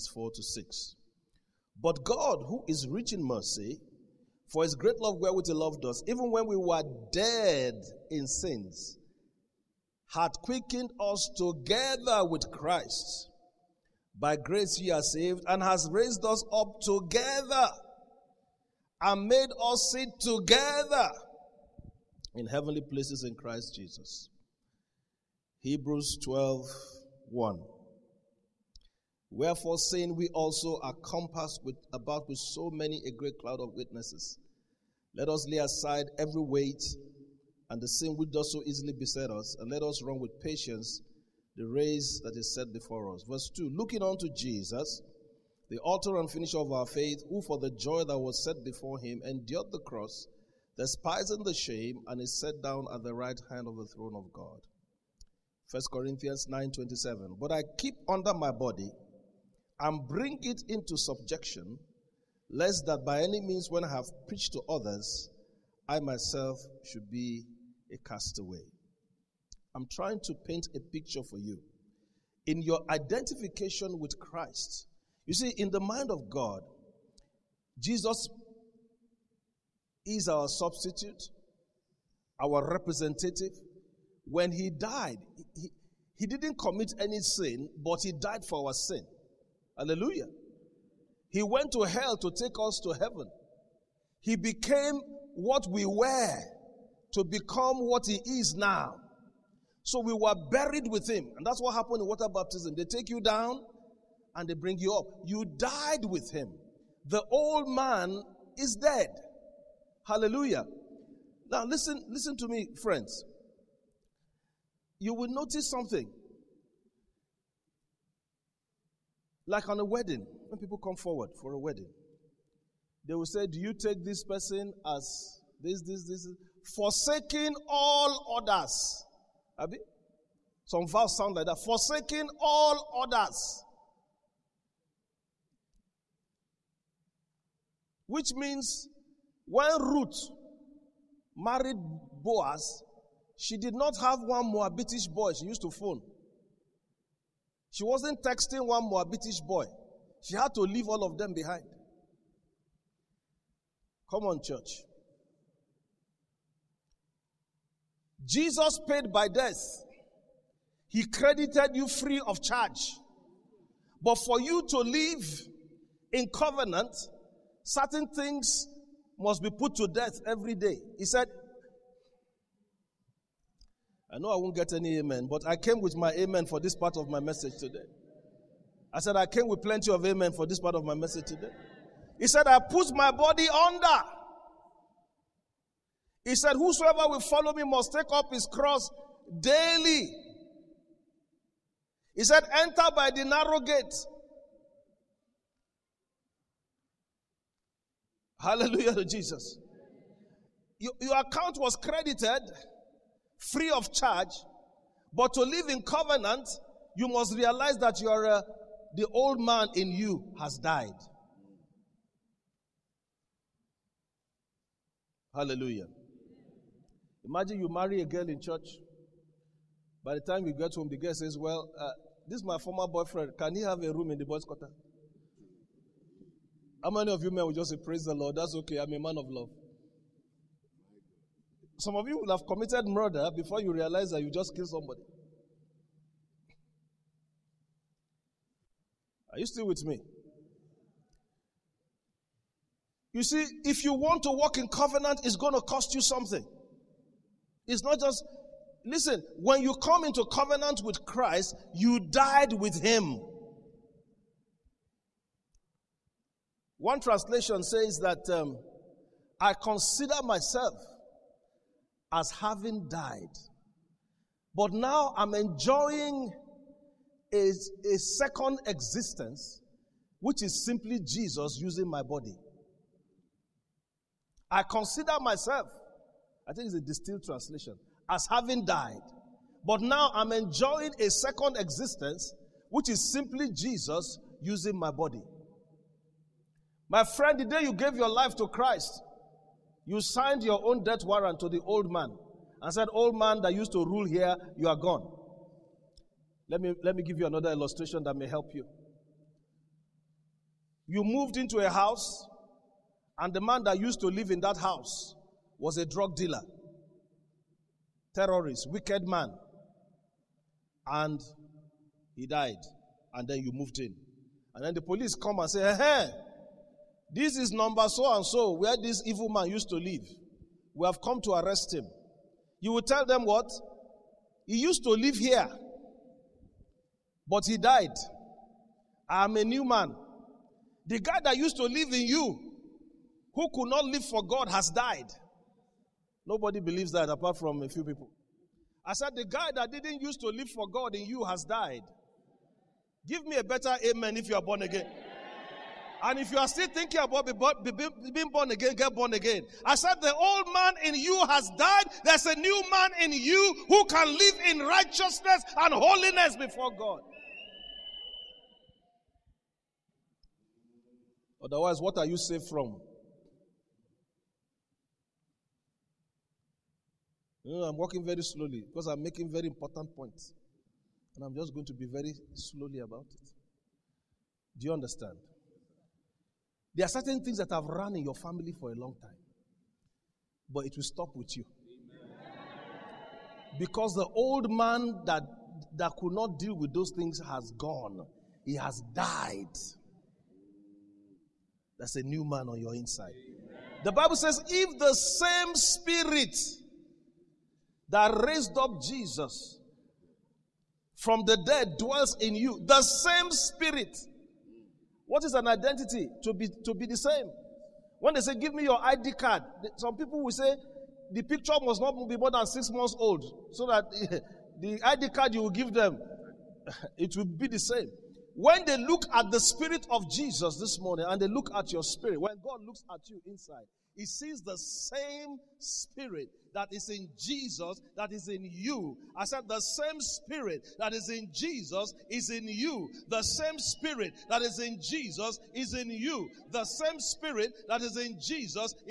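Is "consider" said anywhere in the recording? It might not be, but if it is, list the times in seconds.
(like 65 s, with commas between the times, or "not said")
259 s, 274 s.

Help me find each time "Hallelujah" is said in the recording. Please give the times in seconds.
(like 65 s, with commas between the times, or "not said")
89 s, 110 s, 198 s, 215 s.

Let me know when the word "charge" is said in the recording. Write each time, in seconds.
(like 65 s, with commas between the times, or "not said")
162 s, 203 s.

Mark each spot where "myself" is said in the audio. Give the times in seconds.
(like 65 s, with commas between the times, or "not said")
66 s, 260 s, 275 s.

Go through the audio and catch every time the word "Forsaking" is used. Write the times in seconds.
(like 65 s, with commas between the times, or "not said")
126 s, 131 s.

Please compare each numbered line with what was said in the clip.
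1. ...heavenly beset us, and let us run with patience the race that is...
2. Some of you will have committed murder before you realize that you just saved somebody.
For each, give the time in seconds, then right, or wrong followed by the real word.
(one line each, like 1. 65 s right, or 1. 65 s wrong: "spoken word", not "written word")
1. 38 s wrong: "easily", not "heavenly"
2. 231 s wrong: "killed", not "saved".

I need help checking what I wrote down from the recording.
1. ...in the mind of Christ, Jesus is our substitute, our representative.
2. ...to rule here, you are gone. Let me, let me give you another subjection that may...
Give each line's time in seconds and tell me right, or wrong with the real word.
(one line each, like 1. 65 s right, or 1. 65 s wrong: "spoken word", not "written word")
1. 75 s wrong: "God", not "Christ"
2. 293 s wrong: "illustration", not "subjection".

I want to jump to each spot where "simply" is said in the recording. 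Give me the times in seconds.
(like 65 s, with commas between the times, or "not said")
270 s, 283 s.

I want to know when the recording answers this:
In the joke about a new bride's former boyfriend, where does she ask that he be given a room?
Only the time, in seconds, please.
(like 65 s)
224 s.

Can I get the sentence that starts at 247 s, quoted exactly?
It's not just, listen, when you come into covenant with Christ, you died with Him.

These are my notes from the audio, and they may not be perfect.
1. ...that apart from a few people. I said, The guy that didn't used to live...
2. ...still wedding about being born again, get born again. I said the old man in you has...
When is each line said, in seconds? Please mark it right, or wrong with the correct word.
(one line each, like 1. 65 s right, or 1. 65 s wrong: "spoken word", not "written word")
1. 336 s right
2. 346 s wrong: "thinking", not "wedding".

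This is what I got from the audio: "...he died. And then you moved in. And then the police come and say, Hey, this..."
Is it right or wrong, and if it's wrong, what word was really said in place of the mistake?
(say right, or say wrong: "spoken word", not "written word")
right.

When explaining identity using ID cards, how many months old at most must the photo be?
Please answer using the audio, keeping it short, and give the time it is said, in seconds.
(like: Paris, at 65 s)
6, at 412 s.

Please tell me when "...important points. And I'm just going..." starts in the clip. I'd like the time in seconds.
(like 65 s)
369 s.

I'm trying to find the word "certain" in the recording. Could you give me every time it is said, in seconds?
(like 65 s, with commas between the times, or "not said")
167 s, 376 s.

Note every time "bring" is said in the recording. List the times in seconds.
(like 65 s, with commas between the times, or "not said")
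60 s, 104 s.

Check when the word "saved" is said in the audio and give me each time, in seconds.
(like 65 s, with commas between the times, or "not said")
15 s, 362 s.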